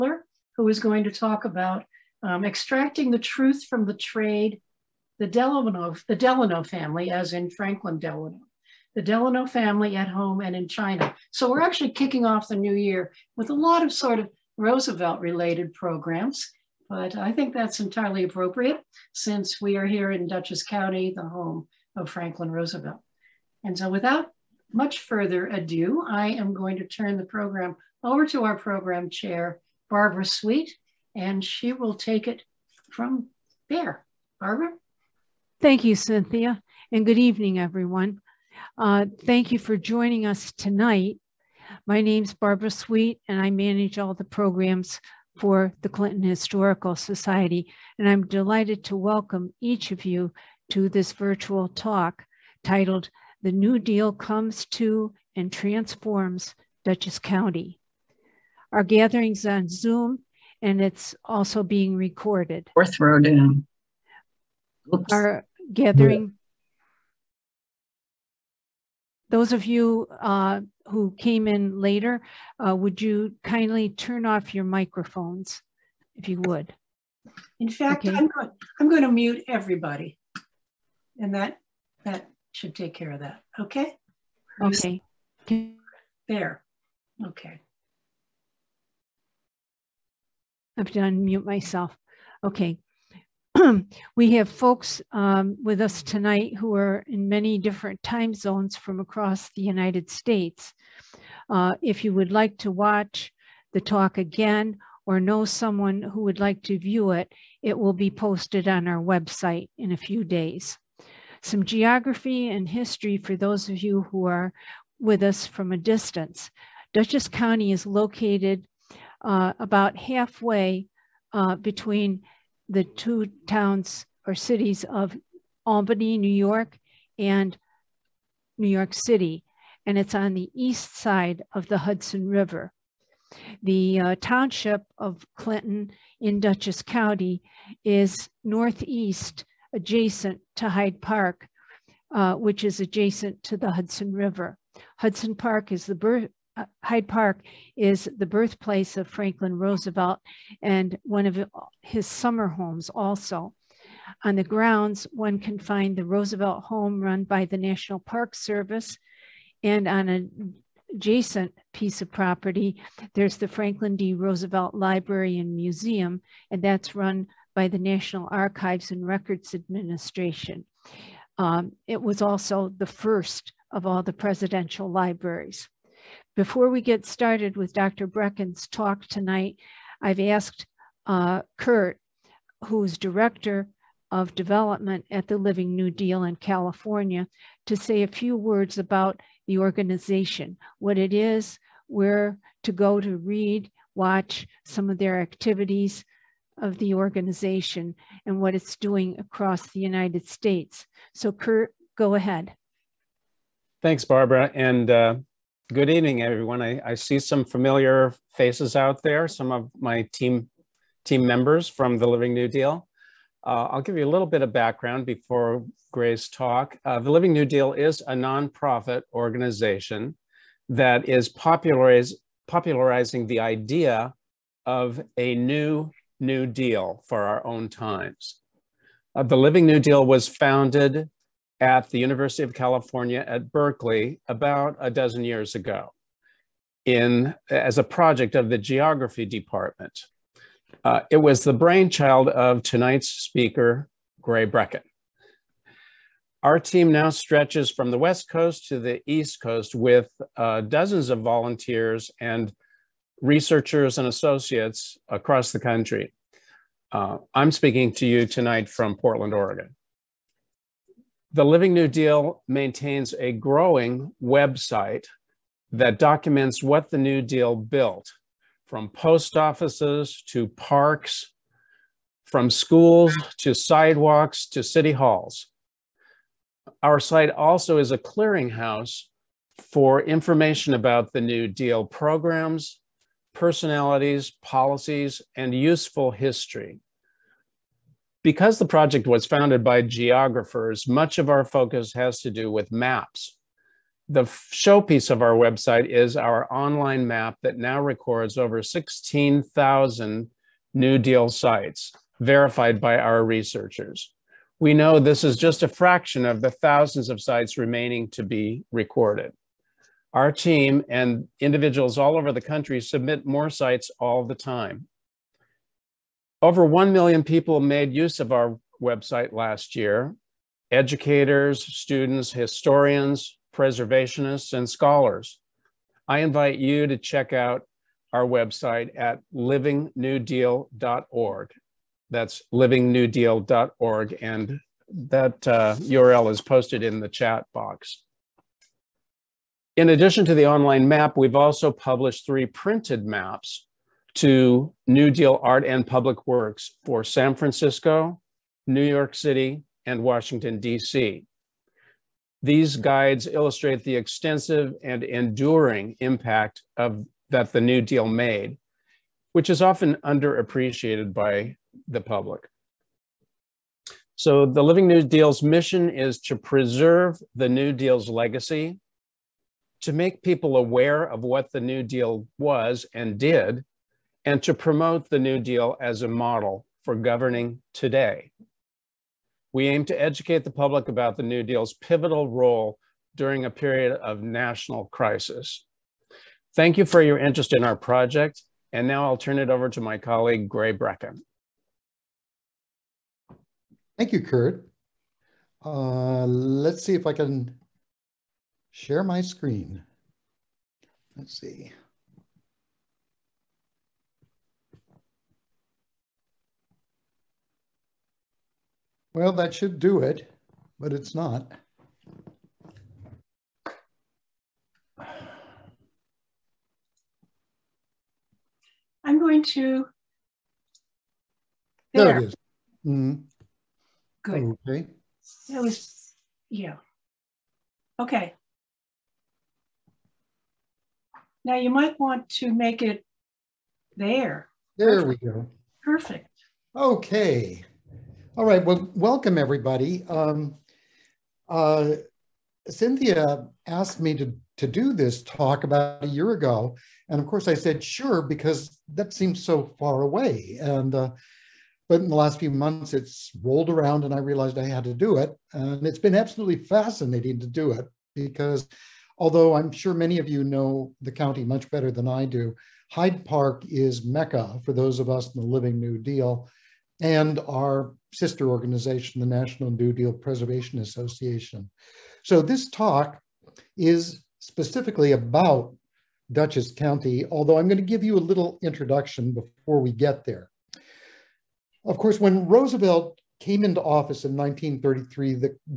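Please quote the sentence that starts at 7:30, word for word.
And uh, but in the last few months it's rolled around and I realized I had to do it.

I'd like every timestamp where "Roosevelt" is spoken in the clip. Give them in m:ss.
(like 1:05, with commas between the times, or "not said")
0:14, 0:22, 2:29, 2:36, 2:44, 8:02.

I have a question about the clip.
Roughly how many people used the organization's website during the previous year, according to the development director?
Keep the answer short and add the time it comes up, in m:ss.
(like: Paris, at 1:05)
1 million, at 5:16.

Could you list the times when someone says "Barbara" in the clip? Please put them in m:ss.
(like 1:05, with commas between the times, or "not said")
0:29, 0:34, 0:42, 3:24.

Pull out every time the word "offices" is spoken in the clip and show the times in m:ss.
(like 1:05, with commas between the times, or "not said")
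4:29, 8:03.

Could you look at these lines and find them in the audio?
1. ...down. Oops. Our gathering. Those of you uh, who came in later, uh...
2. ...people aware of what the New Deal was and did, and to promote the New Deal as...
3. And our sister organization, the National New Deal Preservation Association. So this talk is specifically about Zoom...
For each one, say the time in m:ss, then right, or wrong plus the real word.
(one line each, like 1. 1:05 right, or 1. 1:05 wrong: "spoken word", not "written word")
1. 1:03 right
2. 6:10 right
3. 7:46 wrong: "Dutchess", not "Zoom".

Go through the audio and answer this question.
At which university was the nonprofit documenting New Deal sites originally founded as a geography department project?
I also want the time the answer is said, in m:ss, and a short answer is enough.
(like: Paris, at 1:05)
University of California at Berkeley, at 3:51.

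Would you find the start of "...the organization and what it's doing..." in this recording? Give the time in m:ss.
3:16.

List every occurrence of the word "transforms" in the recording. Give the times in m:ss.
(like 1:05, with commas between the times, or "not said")
0:55.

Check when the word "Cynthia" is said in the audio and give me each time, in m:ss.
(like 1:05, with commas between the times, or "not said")
0:35, 7:22.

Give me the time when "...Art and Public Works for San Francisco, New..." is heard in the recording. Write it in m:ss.
5:45.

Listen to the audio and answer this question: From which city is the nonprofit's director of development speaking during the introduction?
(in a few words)
Portland, Oregon.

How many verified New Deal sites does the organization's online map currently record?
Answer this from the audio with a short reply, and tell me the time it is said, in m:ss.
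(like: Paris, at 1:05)
16,000, at 4:58.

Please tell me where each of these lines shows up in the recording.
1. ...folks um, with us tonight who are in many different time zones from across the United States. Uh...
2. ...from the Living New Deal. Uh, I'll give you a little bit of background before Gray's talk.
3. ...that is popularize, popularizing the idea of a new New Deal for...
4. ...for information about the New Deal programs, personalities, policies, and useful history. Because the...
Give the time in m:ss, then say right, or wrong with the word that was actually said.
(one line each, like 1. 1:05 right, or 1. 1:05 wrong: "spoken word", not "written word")
1. 1:34 right
2. 3:31 right
3. 3:40 right
4. 4:39 right.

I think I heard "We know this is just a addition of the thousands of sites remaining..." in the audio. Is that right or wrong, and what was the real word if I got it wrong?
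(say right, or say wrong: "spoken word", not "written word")
wrong: "fraction", not "addition".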